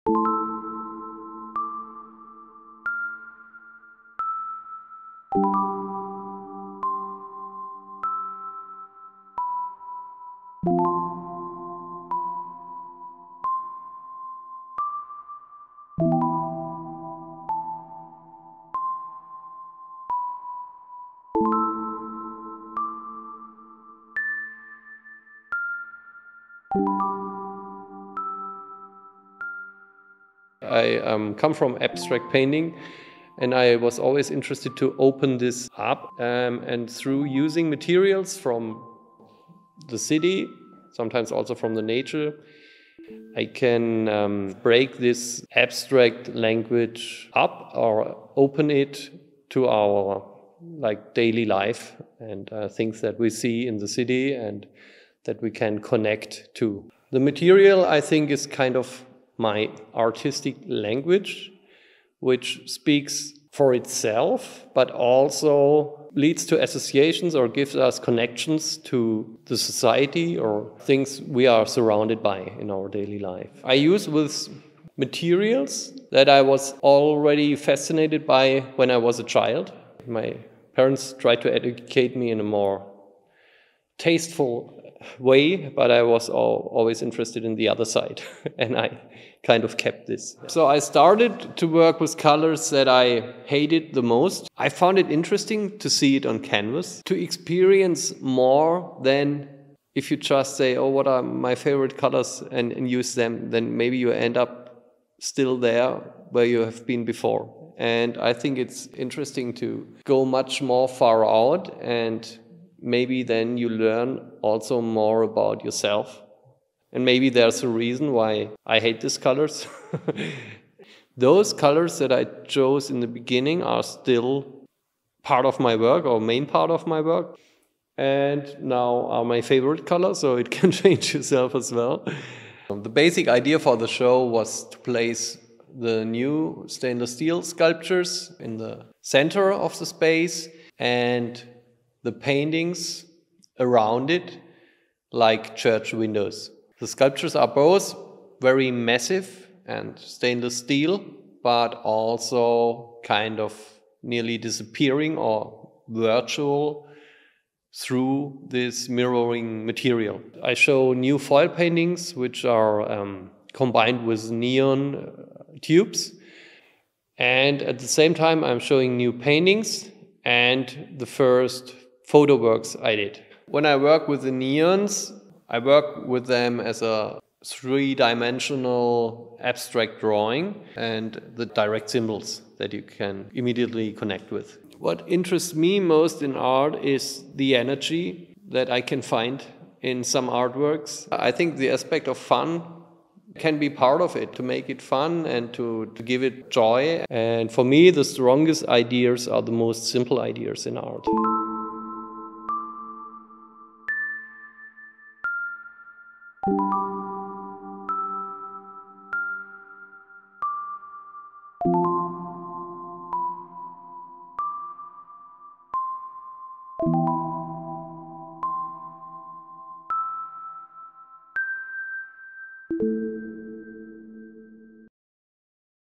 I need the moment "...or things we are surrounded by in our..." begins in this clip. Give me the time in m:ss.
1:10.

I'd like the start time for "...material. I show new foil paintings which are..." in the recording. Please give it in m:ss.
2:39.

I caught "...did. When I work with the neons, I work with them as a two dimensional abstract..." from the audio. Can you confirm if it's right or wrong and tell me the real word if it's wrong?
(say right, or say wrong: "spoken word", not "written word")
wrong: "three", not "two".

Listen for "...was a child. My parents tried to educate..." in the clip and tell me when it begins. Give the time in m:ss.
1:18.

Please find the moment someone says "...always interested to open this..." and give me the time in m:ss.
0:33.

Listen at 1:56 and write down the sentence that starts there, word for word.
And maybe there's a reason why I hate these colors.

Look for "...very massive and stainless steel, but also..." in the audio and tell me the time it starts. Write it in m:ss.
2:28.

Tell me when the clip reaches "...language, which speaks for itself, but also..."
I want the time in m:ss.
1:00.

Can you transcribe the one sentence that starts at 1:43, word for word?
Then maybe you end up still there where you have been before.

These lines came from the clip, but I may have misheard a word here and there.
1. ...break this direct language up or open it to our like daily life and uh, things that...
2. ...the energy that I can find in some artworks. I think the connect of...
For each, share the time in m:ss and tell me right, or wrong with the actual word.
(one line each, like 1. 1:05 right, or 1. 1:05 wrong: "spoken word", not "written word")
1. 0:44 wrong: "abstract", not "direct"
2. 3:07 wrong: "aspect", not "connect".